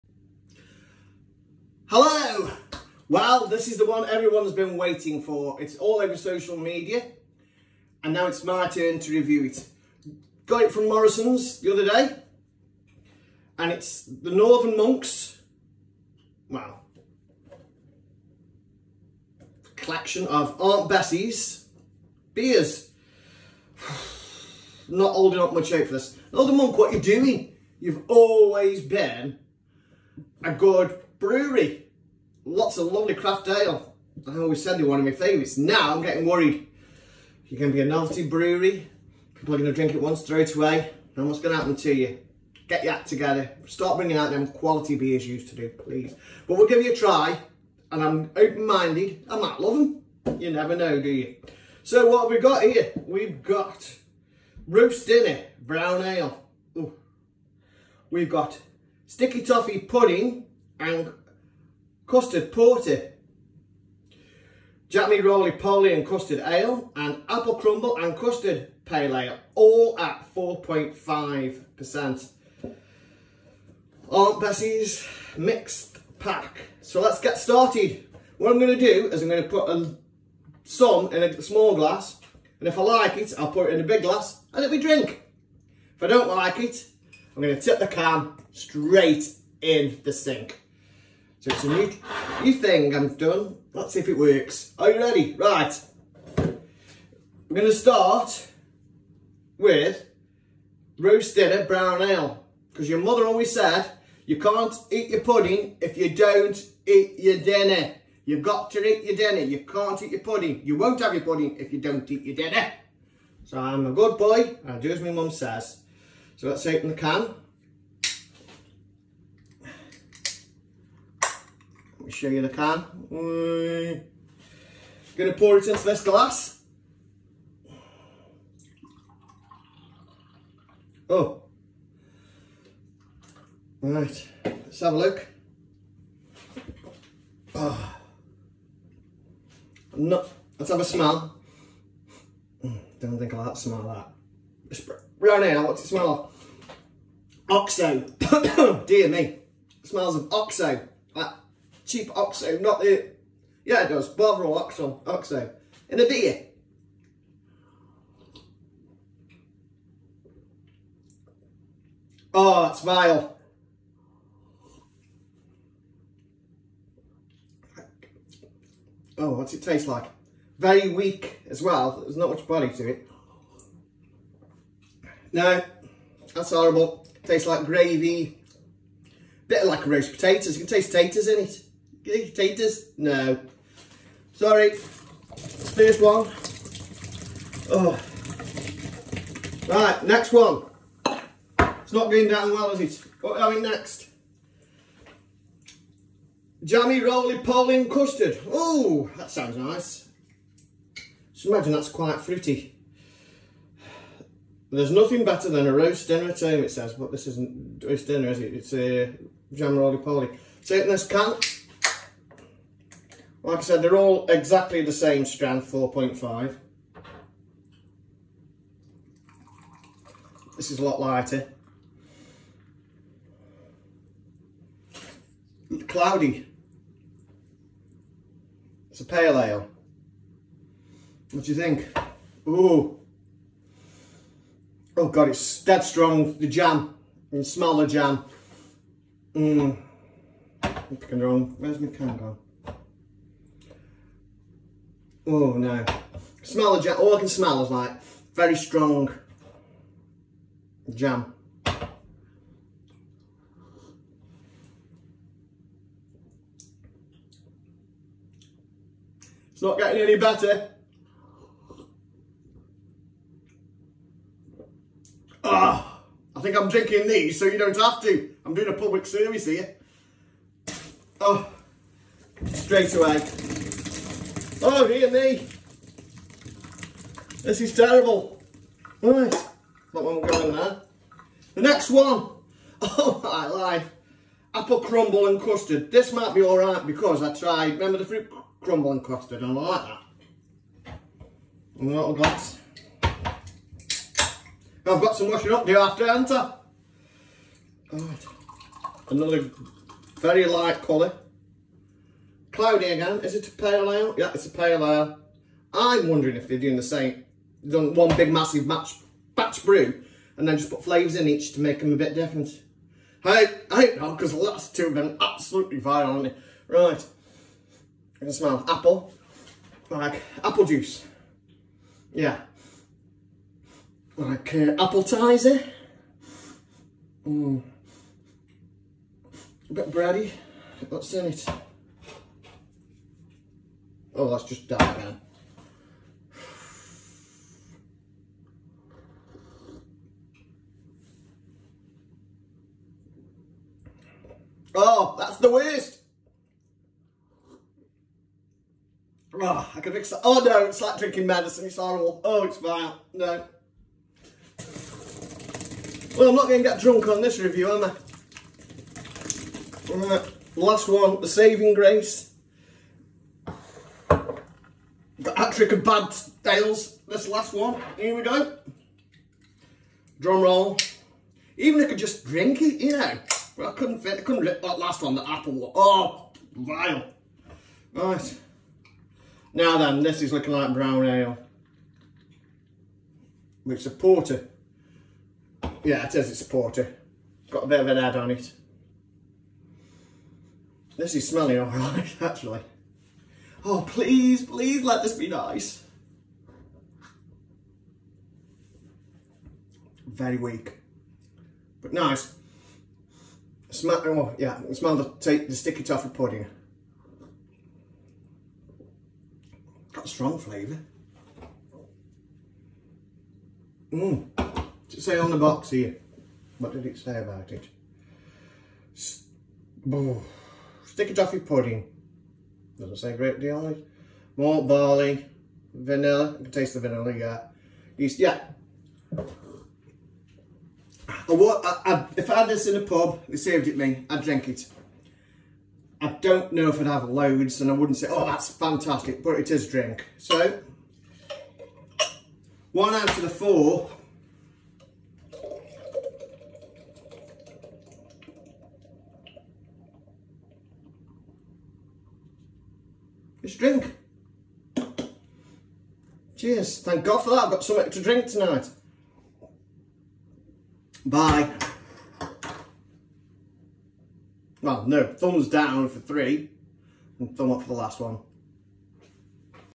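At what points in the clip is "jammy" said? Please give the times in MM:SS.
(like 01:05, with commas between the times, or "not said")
01:04, 03:16.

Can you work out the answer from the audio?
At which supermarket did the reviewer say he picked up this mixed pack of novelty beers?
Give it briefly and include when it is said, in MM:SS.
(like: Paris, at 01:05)
Morrison's, at 00:10.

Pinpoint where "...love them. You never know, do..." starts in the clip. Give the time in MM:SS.
00:49.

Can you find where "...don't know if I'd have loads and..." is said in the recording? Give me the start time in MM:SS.
07:16.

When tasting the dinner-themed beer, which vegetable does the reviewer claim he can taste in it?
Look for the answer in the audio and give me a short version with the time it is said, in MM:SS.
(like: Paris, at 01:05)
roast potatoes, at 02:59.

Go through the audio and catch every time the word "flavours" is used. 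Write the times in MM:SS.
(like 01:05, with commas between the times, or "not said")
05:10, 06:50.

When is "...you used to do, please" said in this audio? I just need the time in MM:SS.
00:45.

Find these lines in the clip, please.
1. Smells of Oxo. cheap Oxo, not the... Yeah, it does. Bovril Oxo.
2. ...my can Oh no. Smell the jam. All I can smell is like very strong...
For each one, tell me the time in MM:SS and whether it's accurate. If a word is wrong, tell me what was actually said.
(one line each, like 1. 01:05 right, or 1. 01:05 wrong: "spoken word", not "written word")
1. 02:29 right
2. 04:01 right.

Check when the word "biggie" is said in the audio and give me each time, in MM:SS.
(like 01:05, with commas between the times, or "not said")
not said.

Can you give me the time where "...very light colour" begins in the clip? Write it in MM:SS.
05:00.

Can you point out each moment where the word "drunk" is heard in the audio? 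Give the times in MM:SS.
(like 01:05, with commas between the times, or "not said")
05:56.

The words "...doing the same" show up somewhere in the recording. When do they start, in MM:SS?
05:06.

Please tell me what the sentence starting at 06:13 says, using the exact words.
But I couldn't fit, I couldn't rip that last one, the apple one.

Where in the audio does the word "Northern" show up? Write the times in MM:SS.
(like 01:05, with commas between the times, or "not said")
00:14, 00:26.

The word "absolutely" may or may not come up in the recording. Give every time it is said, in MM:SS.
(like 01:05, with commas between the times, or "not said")
05:15.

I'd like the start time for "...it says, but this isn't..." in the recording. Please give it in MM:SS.
03:26.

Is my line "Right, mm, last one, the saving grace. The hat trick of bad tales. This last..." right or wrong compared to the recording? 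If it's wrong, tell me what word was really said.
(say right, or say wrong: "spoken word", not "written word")
right.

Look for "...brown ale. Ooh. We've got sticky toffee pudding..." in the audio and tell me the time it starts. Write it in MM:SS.
00:55.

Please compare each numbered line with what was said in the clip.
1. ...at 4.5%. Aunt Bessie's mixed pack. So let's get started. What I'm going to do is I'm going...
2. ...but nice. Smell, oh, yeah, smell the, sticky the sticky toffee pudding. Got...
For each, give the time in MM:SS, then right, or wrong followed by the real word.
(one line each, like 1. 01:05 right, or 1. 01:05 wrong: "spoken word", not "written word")
1. 01:09 right
2. 06:41 right.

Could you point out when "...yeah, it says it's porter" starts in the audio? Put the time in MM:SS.
06:25.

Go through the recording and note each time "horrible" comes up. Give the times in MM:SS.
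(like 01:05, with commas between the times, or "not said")
02:56, 05:51.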